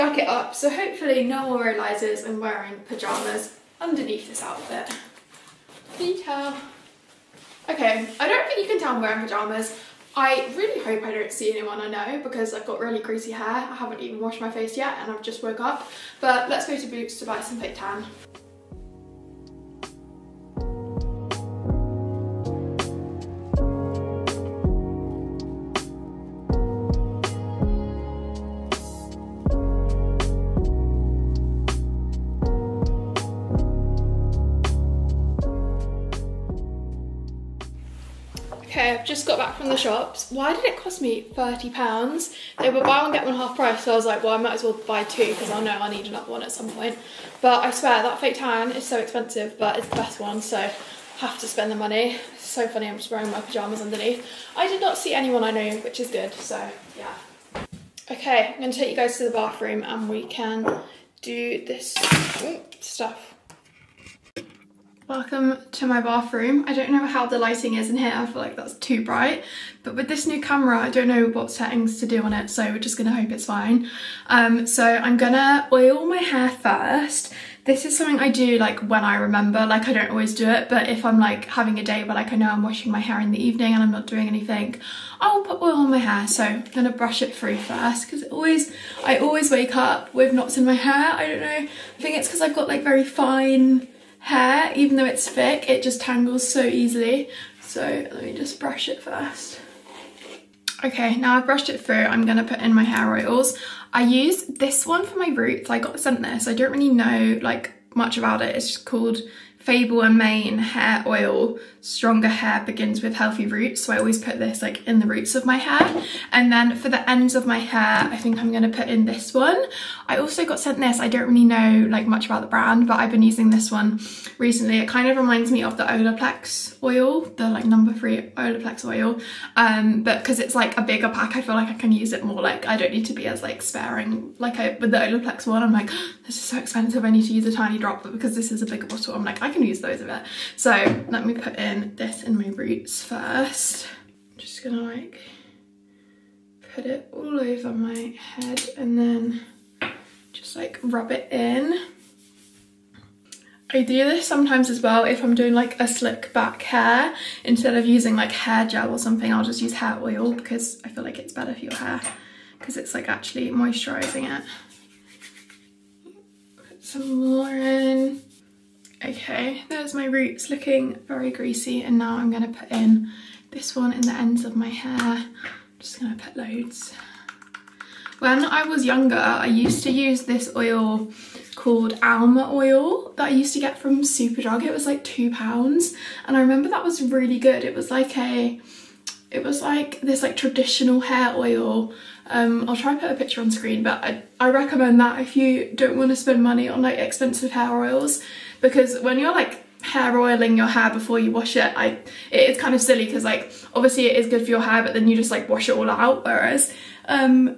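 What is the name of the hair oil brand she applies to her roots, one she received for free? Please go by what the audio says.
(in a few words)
Fable and Mane.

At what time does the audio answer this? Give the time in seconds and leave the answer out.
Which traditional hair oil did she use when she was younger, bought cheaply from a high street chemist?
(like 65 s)
182 s.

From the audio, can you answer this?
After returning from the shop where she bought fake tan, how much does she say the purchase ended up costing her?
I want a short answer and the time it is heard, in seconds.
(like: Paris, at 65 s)
£30, at 41 s.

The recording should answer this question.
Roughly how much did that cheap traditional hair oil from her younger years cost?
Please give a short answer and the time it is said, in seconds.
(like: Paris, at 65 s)
2 pounds, at 185 s.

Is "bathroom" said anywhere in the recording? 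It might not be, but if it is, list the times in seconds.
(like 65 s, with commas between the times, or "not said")
59 s, 66 s.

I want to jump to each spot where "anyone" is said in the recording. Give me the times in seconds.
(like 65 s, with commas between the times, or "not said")
11 s, 55 s.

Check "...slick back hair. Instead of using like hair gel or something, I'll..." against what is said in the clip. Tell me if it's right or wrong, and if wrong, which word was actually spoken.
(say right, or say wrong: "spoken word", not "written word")
right.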